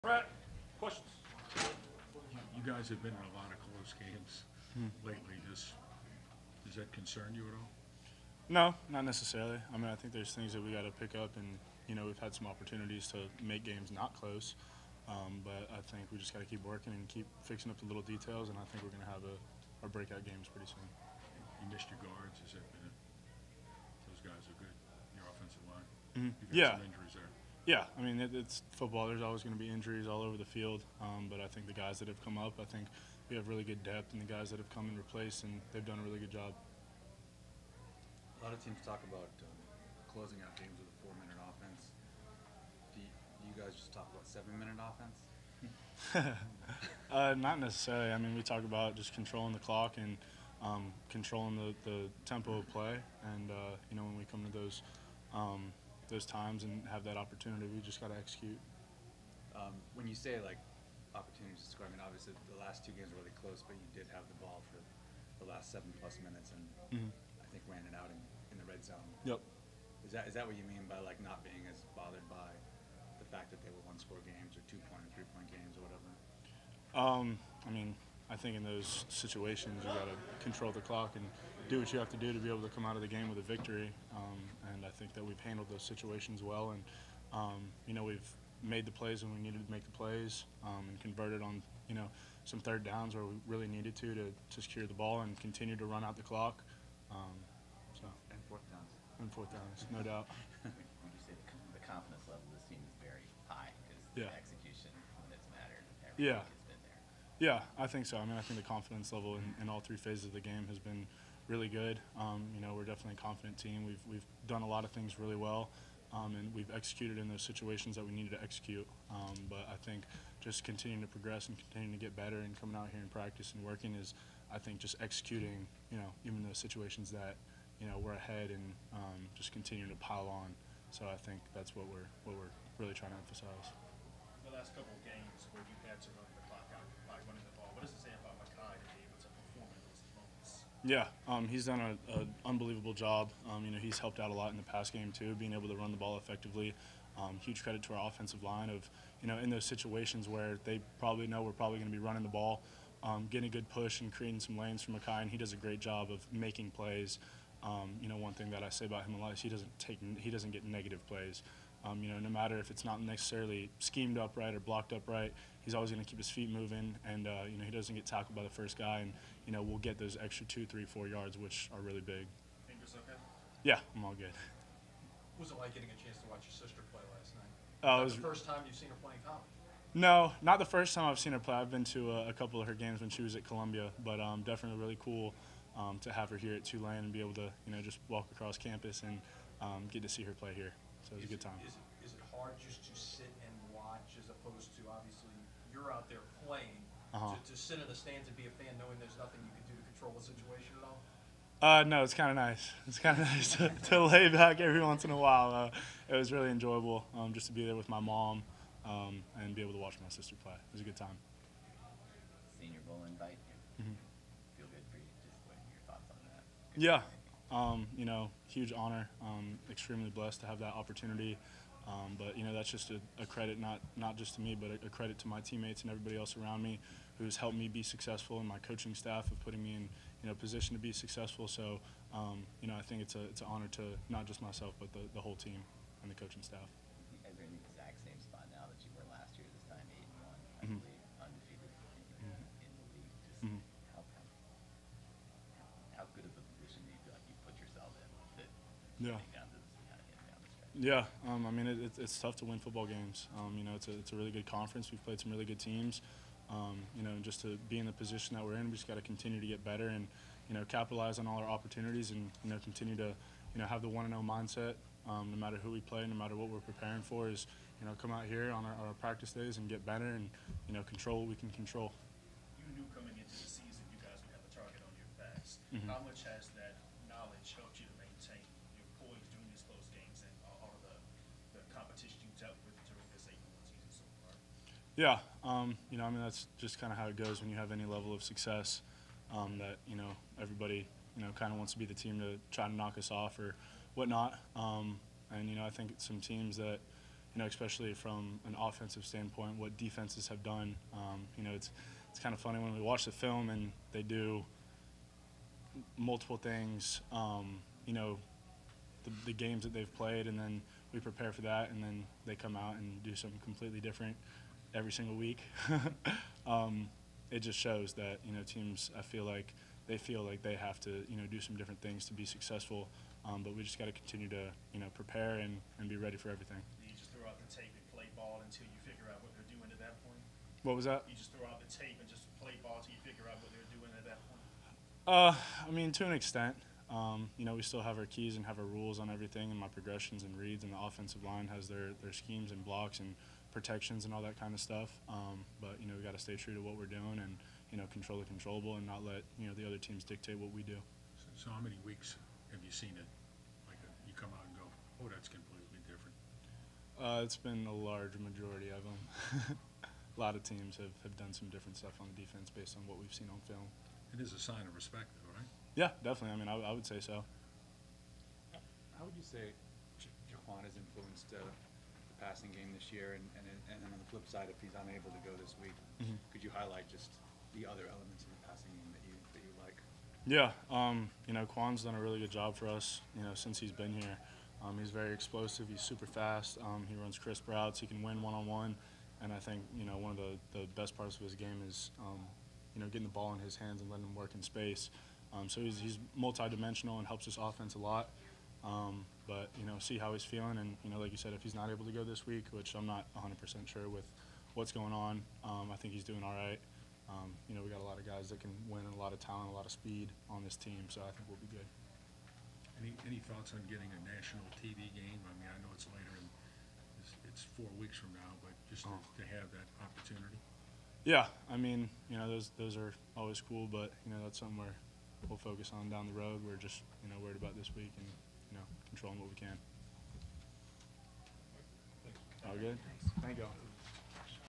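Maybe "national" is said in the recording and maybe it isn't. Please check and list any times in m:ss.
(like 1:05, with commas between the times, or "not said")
6:54.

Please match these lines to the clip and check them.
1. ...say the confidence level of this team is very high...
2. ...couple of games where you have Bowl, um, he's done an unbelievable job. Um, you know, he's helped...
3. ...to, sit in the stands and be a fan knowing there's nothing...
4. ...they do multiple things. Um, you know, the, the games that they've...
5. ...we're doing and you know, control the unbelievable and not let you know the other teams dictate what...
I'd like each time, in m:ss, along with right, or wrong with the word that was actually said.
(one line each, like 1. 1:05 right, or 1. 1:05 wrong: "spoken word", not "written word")
1. 1:41 right
2. 2:14 wrong: "Yeah", not "Bowl"
3. 3:17 right
4. 5:03 right
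5. 5:46 wrong: "controllable", not "unbelievable".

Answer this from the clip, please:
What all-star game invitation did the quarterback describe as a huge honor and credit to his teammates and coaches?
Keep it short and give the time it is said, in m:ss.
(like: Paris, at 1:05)
Senior Bowl, at 3:32.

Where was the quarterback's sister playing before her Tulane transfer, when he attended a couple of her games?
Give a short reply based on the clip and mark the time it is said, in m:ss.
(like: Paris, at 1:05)
Columbia, at 3:03.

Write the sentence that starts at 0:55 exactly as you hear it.
Um, those times and have that opportunity.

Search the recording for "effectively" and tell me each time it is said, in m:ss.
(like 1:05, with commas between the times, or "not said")
2:26.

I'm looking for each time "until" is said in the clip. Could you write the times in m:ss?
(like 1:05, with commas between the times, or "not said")
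5:28, 5:32.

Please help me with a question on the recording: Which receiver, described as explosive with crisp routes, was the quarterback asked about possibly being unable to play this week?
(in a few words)
Jha'Quan.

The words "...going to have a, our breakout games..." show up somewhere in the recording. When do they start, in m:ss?
0:18.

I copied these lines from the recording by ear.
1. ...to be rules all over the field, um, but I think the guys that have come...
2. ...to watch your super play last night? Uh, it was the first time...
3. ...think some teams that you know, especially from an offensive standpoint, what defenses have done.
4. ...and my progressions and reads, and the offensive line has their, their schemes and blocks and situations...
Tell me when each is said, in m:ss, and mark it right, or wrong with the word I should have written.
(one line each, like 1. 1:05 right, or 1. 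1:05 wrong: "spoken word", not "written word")
1. 0:29 wrong: "injuries", not "rules"
2. 2:56 wrong: "sister", not "super"
3. 4:55 right
4. 5:39 wrong: "protections", not "situations".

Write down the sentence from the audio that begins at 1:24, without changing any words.
Um, and I think that we've handled those situations well.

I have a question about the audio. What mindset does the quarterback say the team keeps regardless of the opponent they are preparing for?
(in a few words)
1-0 mindset.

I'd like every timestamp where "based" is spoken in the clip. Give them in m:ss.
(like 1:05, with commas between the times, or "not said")
6:02.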